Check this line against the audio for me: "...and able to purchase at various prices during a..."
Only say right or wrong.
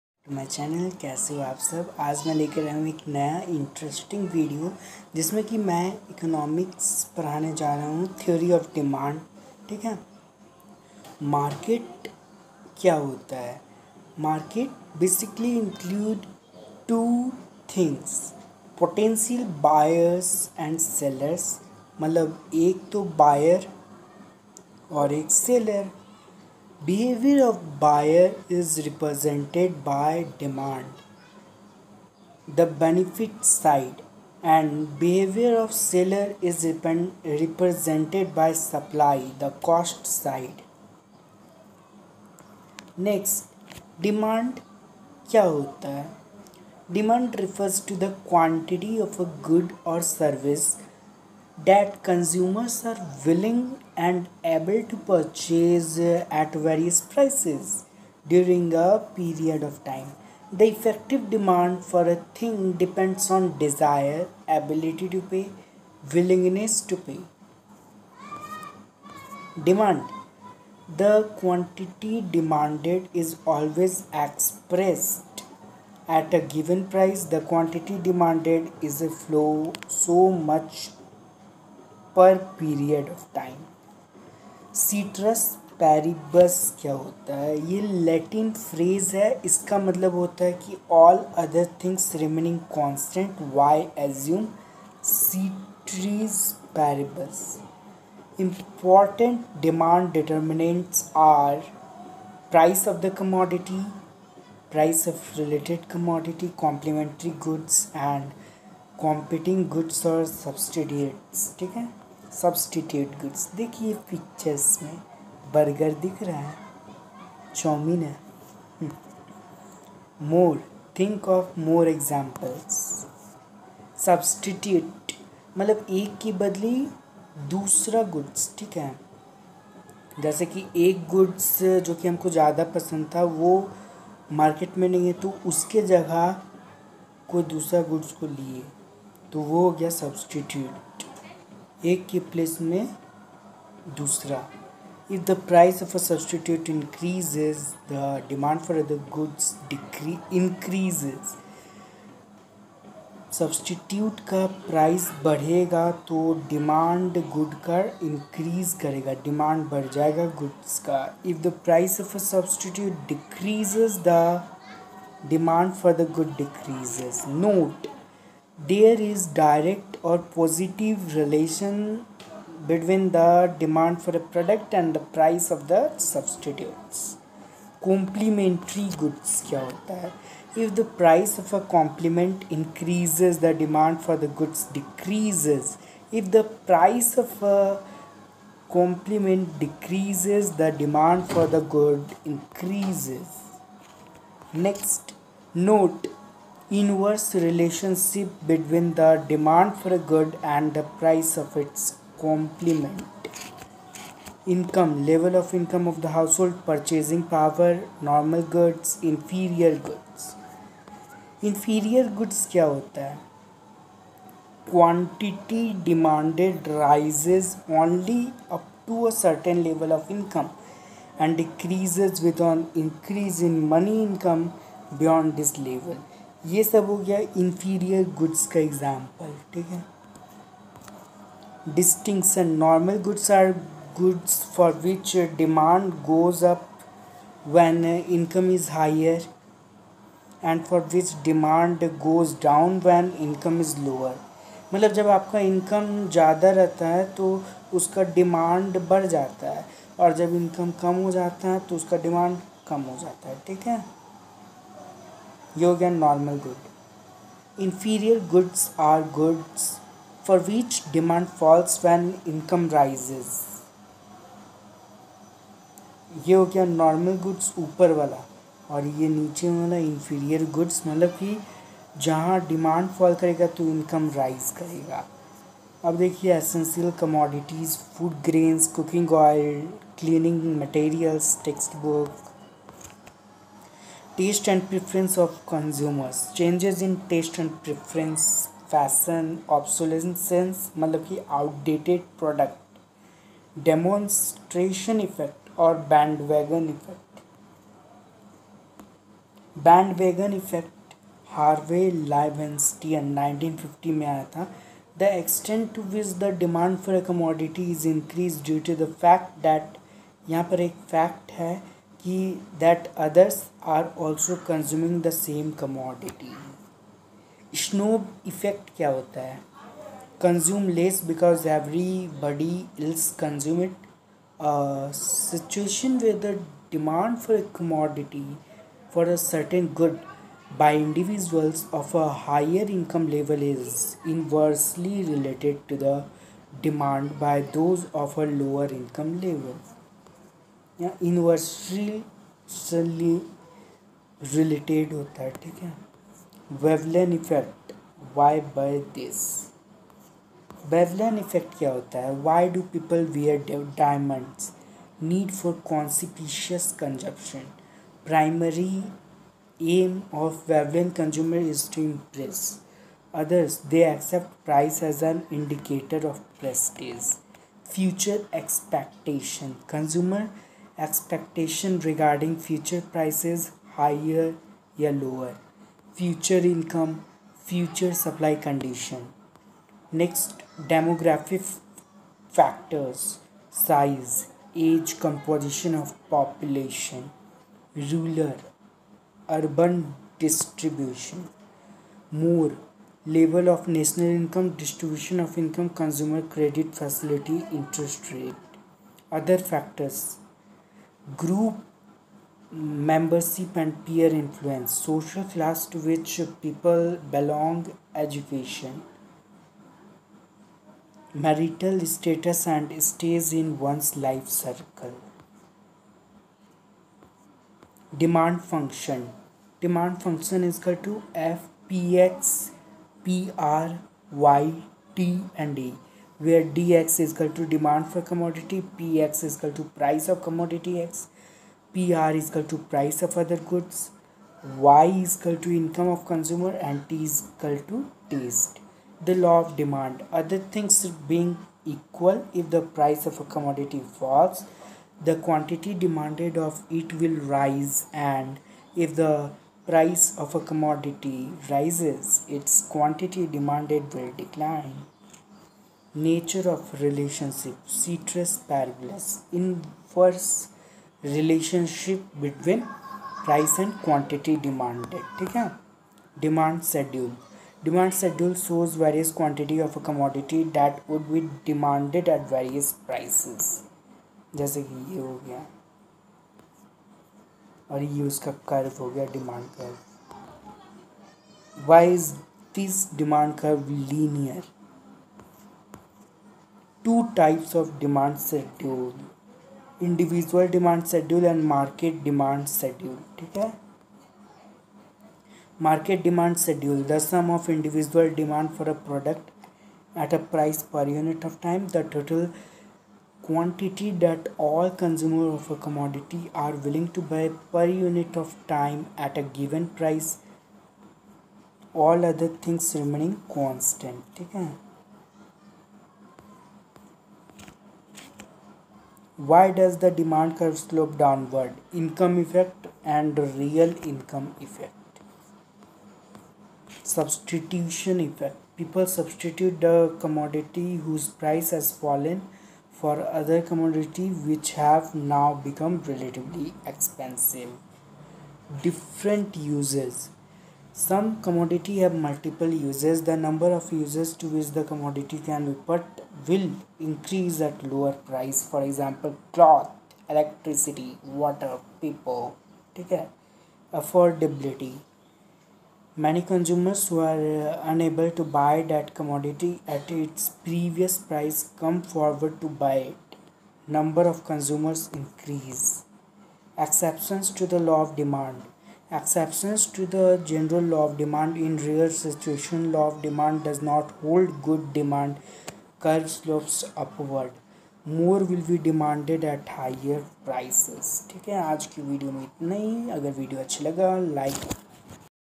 right.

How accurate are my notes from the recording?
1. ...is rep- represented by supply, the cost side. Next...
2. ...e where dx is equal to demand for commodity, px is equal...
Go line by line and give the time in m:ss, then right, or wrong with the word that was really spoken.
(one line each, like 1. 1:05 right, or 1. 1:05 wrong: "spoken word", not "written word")
1. 0:36 right
2. 7:05 right.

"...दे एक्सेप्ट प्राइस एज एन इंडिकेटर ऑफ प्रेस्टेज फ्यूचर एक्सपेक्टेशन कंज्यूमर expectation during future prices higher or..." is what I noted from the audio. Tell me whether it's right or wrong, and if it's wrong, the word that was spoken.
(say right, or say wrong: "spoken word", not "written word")
wrong: "regarding", not "during".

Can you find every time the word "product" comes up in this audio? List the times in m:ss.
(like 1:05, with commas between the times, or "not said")
2:54, 8:18.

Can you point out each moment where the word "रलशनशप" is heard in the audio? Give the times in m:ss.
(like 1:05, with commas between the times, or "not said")
7:36, 7:41.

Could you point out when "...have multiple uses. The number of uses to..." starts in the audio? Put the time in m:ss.
9:01.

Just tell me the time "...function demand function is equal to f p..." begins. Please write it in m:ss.
6:58.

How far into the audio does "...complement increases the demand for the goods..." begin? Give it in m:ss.
3:01.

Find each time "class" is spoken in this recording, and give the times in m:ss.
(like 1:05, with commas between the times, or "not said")
6:45.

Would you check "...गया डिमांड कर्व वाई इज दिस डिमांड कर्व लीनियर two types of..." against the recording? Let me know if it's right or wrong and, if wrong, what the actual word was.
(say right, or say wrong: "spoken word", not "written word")
right.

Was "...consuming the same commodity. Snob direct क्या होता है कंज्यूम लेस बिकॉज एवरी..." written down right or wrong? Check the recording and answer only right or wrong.
wrong.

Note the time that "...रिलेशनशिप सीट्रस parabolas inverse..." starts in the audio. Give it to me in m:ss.
7:36.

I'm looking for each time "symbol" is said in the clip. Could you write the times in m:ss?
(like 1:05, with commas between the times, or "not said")
not said.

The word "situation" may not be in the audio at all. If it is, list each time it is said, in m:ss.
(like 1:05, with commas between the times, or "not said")
5:24, 9:31.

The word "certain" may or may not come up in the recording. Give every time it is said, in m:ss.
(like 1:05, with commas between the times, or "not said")
3:39, 5:29.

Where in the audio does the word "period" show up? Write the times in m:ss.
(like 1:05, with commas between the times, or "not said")
0:59, 1:22.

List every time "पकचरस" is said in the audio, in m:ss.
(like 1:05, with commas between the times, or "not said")
1:54.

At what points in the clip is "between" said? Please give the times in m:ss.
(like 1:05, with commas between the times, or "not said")
2:52, 3:18.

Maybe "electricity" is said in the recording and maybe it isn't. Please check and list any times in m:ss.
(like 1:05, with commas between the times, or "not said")
9:10.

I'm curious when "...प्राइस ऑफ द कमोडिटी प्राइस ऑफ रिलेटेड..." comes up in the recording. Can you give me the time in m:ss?
1:42.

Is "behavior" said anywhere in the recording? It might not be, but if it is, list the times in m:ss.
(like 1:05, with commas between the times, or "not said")
0:26, 0:34.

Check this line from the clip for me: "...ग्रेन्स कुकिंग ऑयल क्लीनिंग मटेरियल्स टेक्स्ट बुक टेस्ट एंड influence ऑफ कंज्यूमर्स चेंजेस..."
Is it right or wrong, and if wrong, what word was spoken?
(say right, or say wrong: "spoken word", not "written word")
wrong: "preference", not "influence".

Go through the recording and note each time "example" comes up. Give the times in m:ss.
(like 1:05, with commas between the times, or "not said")
9:08.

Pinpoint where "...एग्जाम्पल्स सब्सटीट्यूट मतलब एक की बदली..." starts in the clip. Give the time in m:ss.
2:01.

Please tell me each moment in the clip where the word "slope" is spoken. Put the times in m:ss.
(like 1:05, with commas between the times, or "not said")
8:40, 9:36.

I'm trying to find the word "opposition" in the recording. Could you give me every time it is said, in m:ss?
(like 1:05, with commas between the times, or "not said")
not said.